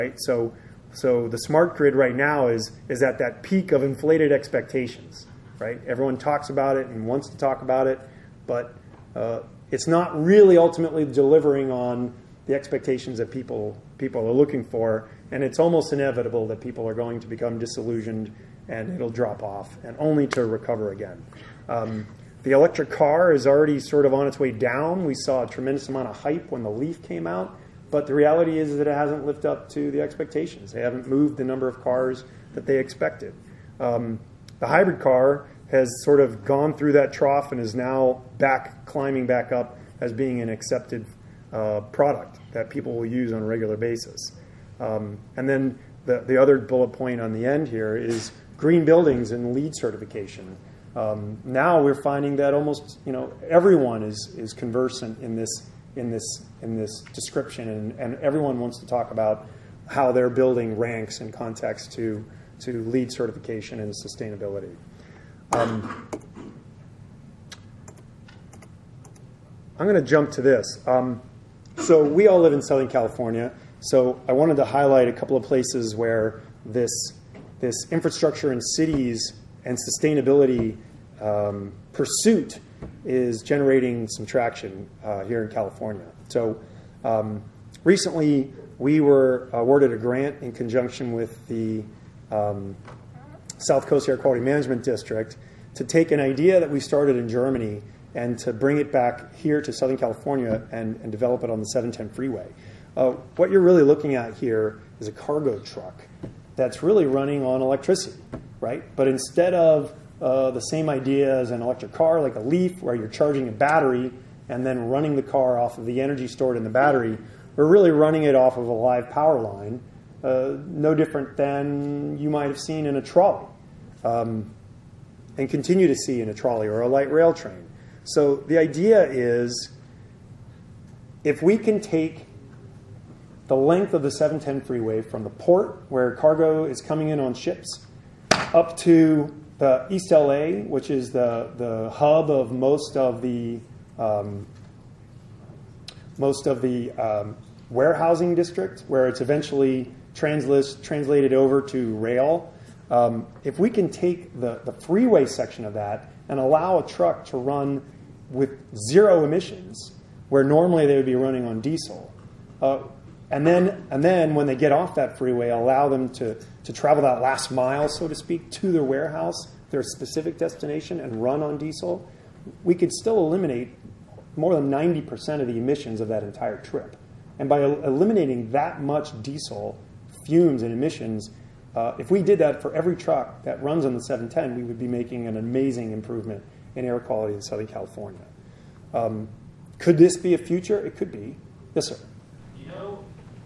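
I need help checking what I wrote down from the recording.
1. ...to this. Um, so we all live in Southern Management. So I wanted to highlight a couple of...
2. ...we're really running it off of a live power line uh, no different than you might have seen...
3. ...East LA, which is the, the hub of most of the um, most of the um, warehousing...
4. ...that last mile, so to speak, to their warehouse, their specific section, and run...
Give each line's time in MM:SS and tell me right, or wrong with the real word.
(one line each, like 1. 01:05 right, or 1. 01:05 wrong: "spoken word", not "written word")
1. 01:10 wrong: "California", not "Management"
2. 01:57 right
3. 02:19 right
4. 02:47 wrong: "destination", not "section".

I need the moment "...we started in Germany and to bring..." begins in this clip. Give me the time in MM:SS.
01:36.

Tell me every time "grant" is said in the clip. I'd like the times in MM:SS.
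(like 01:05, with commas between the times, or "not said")
01:29.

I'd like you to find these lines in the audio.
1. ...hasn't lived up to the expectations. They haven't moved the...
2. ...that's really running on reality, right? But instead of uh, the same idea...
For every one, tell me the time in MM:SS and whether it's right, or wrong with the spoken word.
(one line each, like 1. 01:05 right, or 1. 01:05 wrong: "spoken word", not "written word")
1. 00:28 right
2. 01:46 wrong: "electricity", not "reality".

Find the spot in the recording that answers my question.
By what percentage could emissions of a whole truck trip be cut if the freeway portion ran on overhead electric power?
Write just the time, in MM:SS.
02:54.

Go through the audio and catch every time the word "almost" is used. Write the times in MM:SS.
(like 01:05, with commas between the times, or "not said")
00:15, 00:52.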